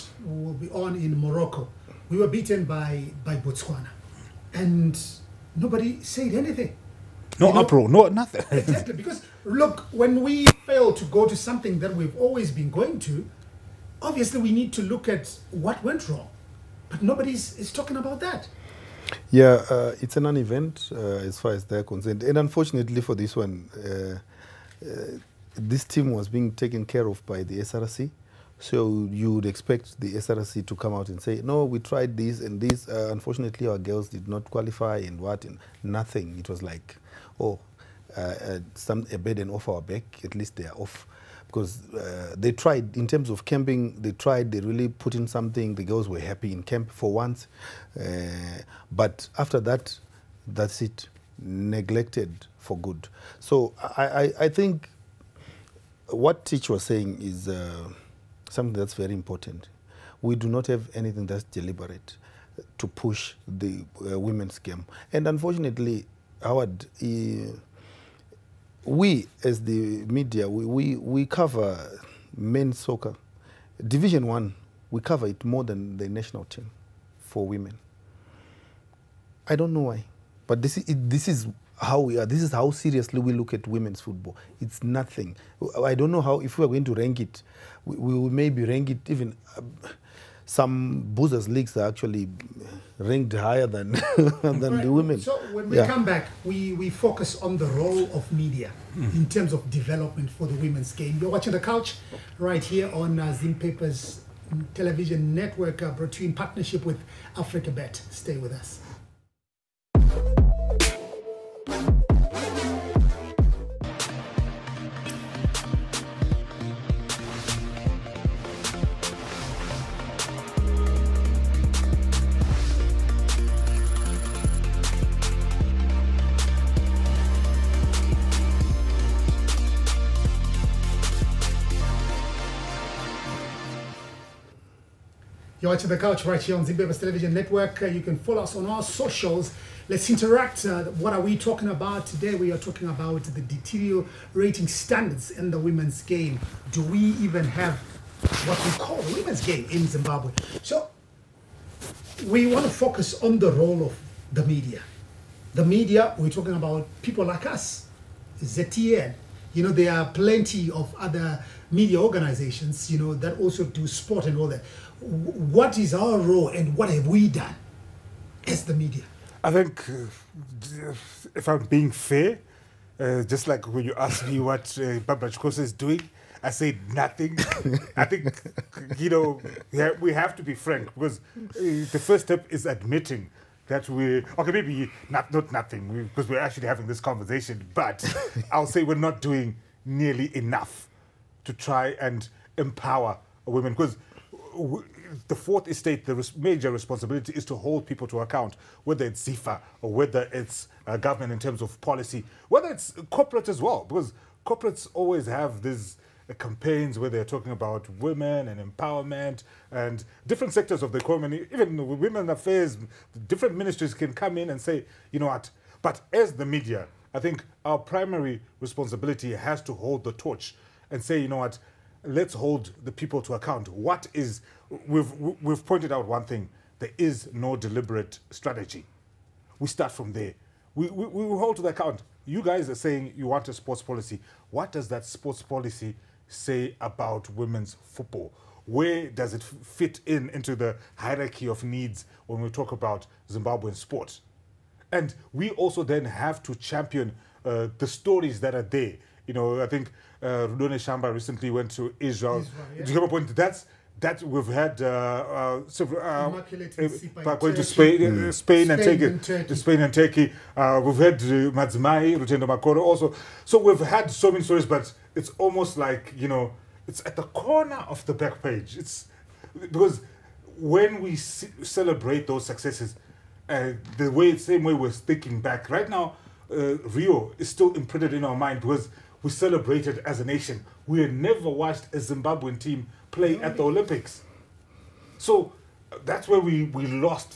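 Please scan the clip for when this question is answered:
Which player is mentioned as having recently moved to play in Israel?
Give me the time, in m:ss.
4:10.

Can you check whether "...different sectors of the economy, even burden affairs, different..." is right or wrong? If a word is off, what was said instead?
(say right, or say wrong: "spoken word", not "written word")
wrong: "women", not "burden".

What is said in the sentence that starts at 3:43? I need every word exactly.
What is we've we've pointed out one thing: there is no deliberate strategy.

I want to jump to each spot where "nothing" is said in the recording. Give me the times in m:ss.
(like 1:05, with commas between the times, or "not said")
0:08, 0:35, 1:24, 2:56, 3:05.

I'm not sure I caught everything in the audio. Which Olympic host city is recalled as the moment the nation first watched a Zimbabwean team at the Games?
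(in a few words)
Rio.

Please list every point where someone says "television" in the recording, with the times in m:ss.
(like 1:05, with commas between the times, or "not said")
1:44, 2:16.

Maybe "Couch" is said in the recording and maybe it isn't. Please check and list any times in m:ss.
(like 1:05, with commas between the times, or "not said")
1:41, 2:15.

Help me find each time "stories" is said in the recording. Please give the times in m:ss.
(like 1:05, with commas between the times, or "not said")
4:07, 4:24.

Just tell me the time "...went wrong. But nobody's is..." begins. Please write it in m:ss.
0:15.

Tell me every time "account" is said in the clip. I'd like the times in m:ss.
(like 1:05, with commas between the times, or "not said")
3:18, 3:43, 3:51.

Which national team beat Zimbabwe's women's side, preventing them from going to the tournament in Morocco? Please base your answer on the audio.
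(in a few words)
Botswana.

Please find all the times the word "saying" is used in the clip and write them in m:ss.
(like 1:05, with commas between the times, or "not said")
0:56, 3:52.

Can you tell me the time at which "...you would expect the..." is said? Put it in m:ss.
0:29.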